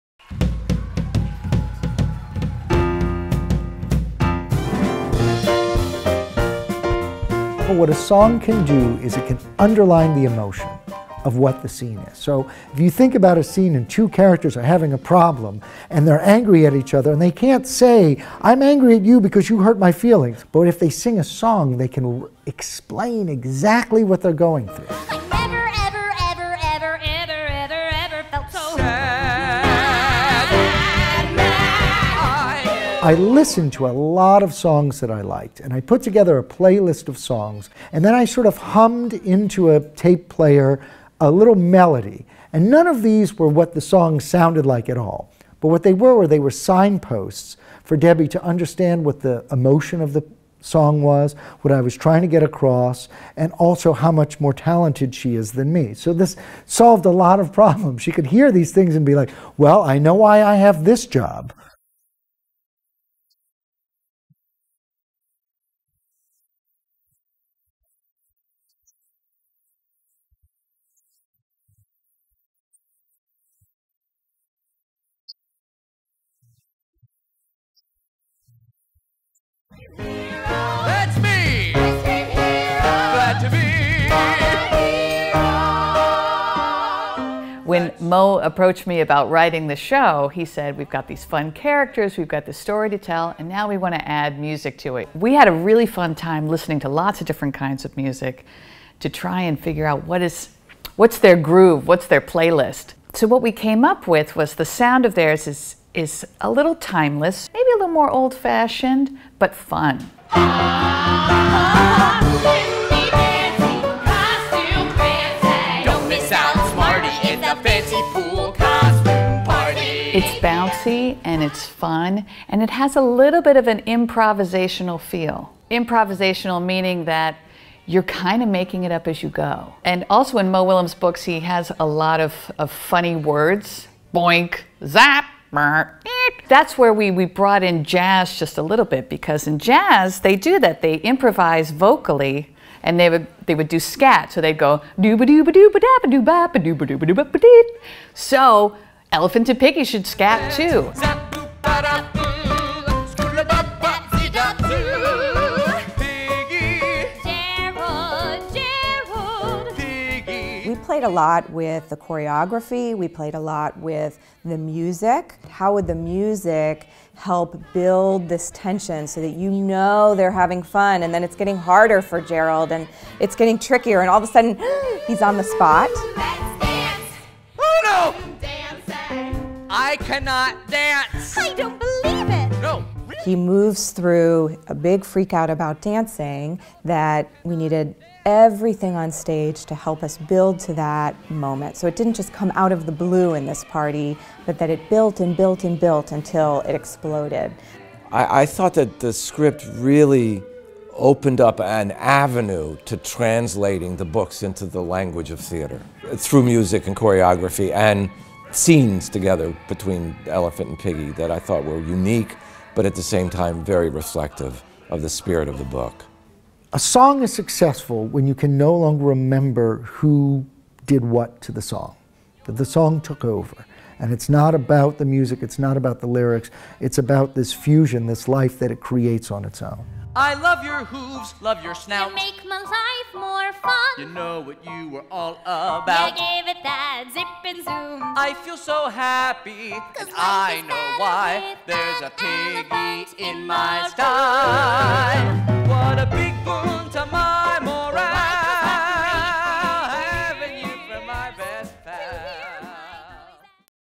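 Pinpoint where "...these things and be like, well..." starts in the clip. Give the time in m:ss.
0:58.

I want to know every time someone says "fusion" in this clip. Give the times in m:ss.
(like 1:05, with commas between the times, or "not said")
3:47.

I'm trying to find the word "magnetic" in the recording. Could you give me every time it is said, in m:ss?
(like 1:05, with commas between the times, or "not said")
not said.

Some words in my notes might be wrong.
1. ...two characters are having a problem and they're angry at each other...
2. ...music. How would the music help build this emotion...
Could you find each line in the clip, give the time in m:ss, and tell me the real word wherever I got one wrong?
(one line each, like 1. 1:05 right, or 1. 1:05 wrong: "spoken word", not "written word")
1. 0:13 right
2. 2:44 wrong: "tension", not "emotion".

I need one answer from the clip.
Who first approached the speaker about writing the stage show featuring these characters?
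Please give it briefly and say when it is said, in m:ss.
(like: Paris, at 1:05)
Mo, at 1:28.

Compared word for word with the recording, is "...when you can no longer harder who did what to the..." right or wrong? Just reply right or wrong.
wrong.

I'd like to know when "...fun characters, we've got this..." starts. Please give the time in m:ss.
1:31.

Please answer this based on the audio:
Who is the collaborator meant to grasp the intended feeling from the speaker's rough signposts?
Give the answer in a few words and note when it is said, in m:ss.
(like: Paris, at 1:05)
Debbie, at 0:47.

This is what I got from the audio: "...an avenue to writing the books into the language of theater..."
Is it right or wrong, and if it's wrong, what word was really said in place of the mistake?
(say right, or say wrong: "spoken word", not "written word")
wrong: "translating", not "writing".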